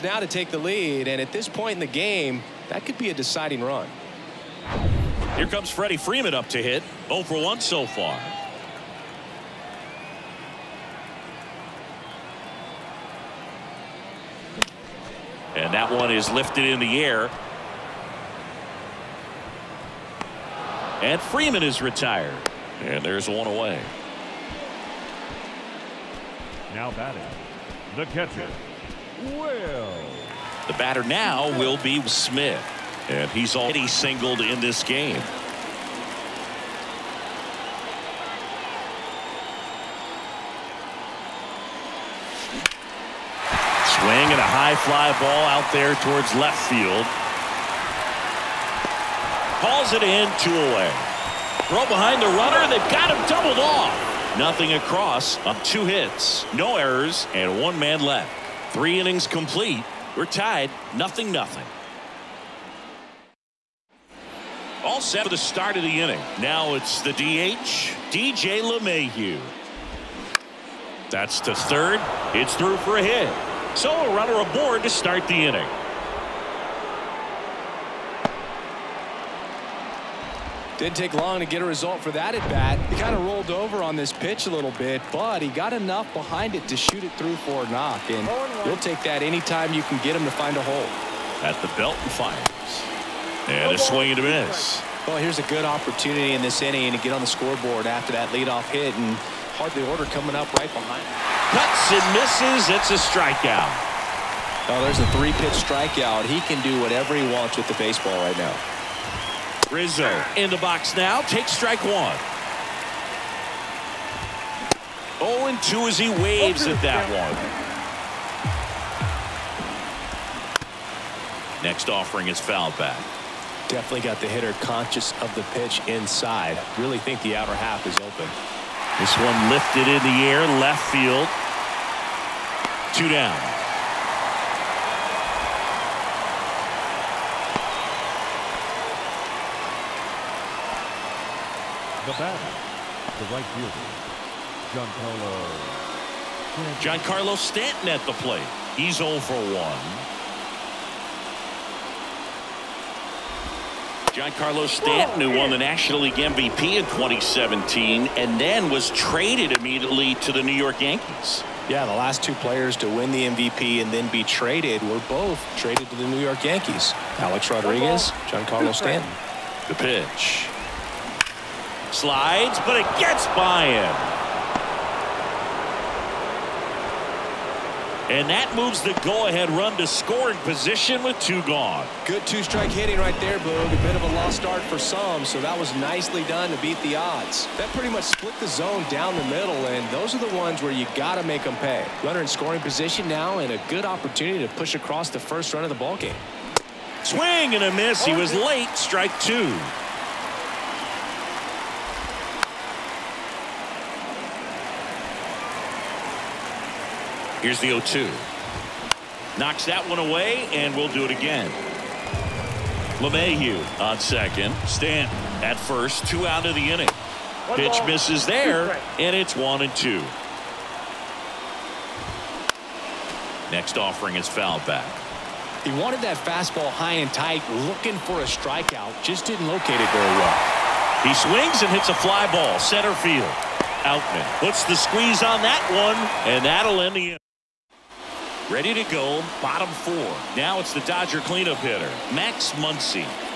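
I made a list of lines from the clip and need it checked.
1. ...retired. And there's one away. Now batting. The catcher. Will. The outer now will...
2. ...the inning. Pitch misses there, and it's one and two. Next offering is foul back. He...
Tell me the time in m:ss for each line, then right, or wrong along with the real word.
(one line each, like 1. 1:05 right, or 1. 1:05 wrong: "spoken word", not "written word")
1. 0:21 wrong: "batter", not "outer"
2. 3:36 right.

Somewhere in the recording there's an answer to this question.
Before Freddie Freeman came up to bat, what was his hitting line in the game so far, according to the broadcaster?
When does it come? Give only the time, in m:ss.
0:07.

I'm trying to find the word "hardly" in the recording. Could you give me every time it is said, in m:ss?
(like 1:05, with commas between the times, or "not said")
1:39.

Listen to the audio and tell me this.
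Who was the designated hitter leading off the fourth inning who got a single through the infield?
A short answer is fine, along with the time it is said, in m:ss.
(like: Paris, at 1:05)
DJ LeMahieu, at 1:08.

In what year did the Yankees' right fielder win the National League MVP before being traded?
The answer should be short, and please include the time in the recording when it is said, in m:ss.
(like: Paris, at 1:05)
2017, at 2:36.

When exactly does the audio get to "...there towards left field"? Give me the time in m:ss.
0:45.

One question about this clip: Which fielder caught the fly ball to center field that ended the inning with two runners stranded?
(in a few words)
Outman.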